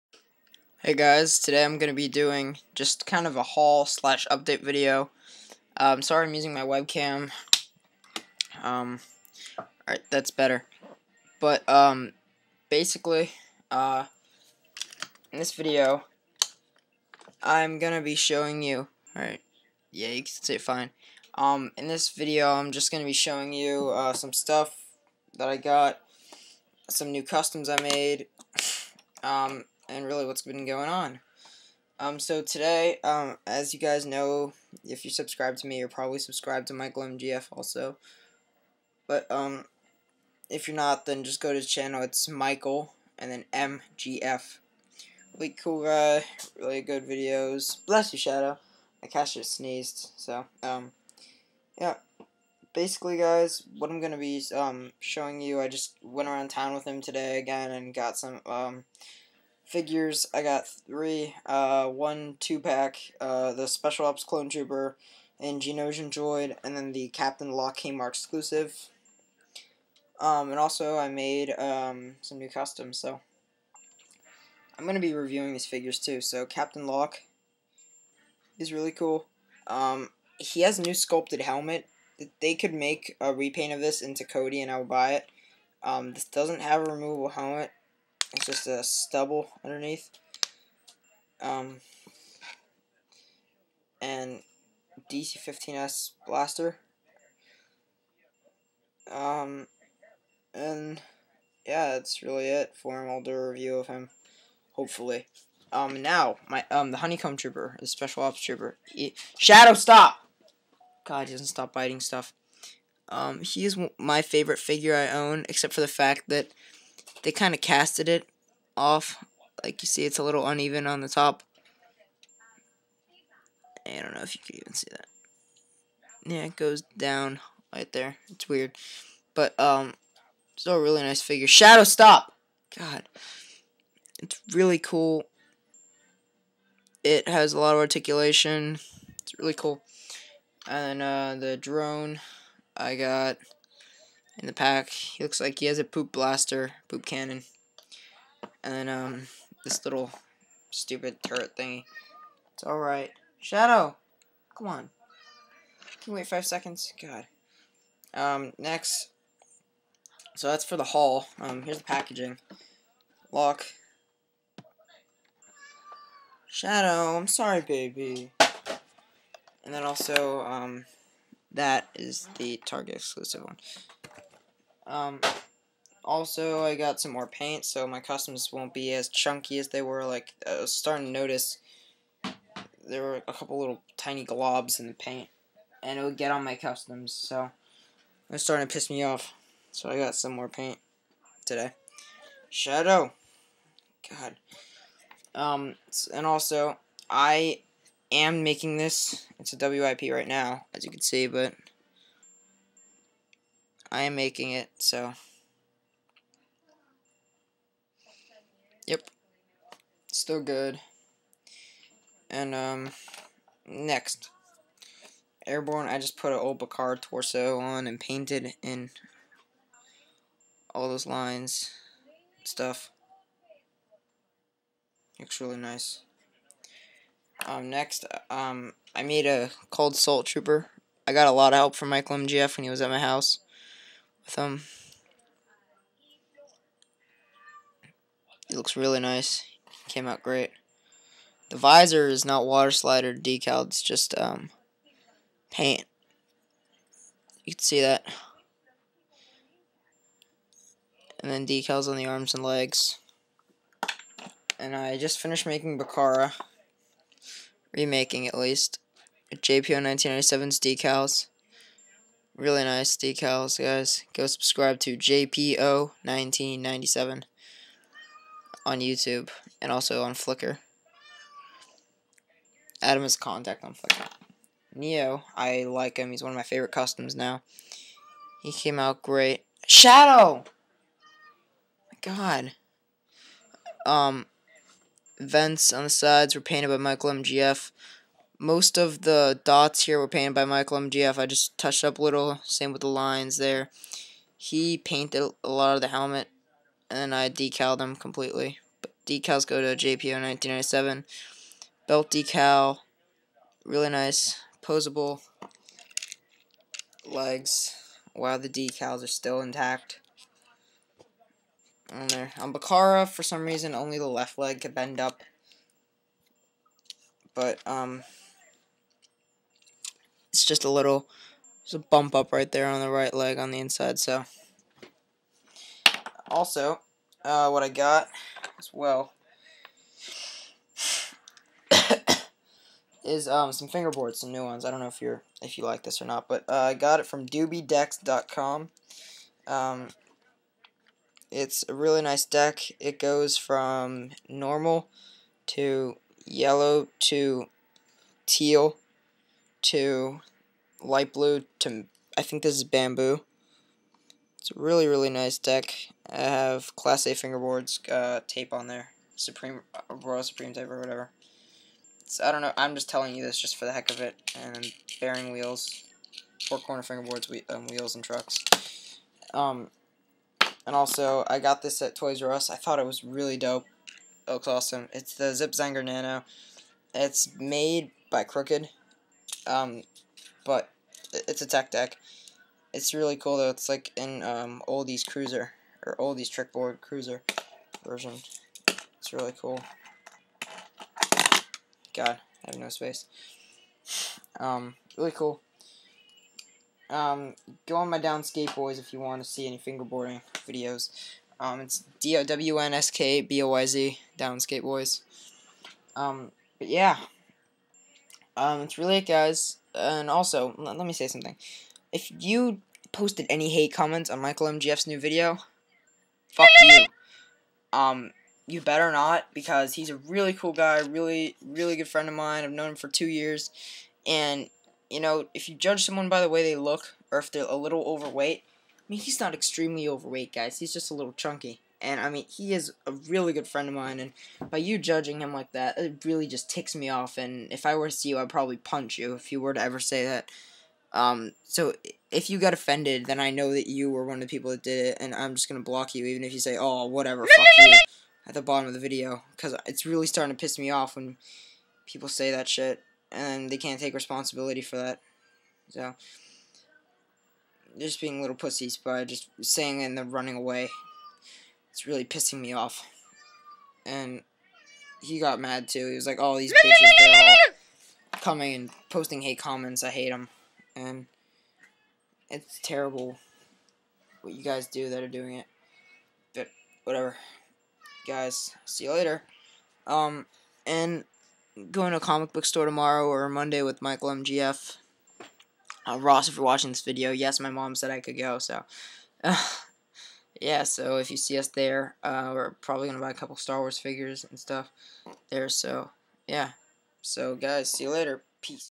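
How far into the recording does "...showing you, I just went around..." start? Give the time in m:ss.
0:55.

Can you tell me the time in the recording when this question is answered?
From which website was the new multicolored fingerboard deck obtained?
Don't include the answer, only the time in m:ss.
5:37.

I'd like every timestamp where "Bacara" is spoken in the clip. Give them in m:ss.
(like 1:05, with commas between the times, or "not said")
3:36, 4:15, 5:12.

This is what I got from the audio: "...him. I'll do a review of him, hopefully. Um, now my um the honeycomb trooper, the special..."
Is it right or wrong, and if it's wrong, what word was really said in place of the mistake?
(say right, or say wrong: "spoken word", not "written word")
right.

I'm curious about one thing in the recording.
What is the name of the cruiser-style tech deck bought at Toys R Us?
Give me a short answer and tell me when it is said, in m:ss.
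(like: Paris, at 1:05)
Zip Zanger Nano, at 6:15.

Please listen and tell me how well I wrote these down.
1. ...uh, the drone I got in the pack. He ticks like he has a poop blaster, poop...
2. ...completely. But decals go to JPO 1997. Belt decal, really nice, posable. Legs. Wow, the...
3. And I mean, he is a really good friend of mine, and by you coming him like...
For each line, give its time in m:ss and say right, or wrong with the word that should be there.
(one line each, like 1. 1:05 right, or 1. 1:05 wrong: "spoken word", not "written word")
1. 2:21 wrong: "looks", not "ticks"
2. 4:57 right
3. 7:11 wrong: "judging", not "coming".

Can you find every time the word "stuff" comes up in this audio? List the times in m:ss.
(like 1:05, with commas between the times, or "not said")
0:24, 1:51, 3:42, 8:14.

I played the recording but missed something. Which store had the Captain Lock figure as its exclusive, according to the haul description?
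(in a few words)
Kmart.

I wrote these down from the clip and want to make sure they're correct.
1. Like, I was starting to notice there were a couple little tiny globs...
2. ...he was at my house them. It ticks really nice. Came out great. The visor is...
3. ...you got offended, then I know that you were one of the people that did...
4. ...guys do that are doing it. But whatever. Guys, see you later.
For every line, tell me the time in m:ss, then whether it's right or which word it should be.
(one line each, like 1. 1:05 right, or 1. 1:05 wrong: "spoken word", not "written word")
1. 3:00 right
2. 3:52 wrong: "looks", not "ticks"
3. 7:22 right
4. 7:54 right.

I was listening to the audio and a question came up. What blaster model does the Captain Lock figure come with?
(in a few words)
DC-15S.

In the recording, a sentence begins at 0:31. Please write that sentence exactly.
Um, so today, um, as you guys know, if you subscribe to me, you're probably subscribed to Michael MGF also.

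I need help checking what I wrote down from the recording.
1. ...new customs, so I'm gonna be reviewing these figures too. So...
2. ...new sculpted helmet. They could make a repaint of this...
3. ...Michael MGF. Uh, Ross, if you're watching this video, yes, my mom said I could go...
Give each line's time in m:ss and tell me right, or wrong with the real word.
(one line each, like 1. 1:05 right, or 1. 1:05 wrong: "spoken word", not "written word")
1. 1:12 right
2. 1:20 right
3. 8:03 right.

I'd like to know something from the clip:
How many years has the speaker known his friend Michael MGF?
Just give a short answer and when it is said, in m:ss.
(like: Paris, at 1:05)
2, at 7:02.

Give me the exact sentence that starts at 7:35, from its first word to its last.
So just being little pussies by just saying and then running away it's really pissing me off.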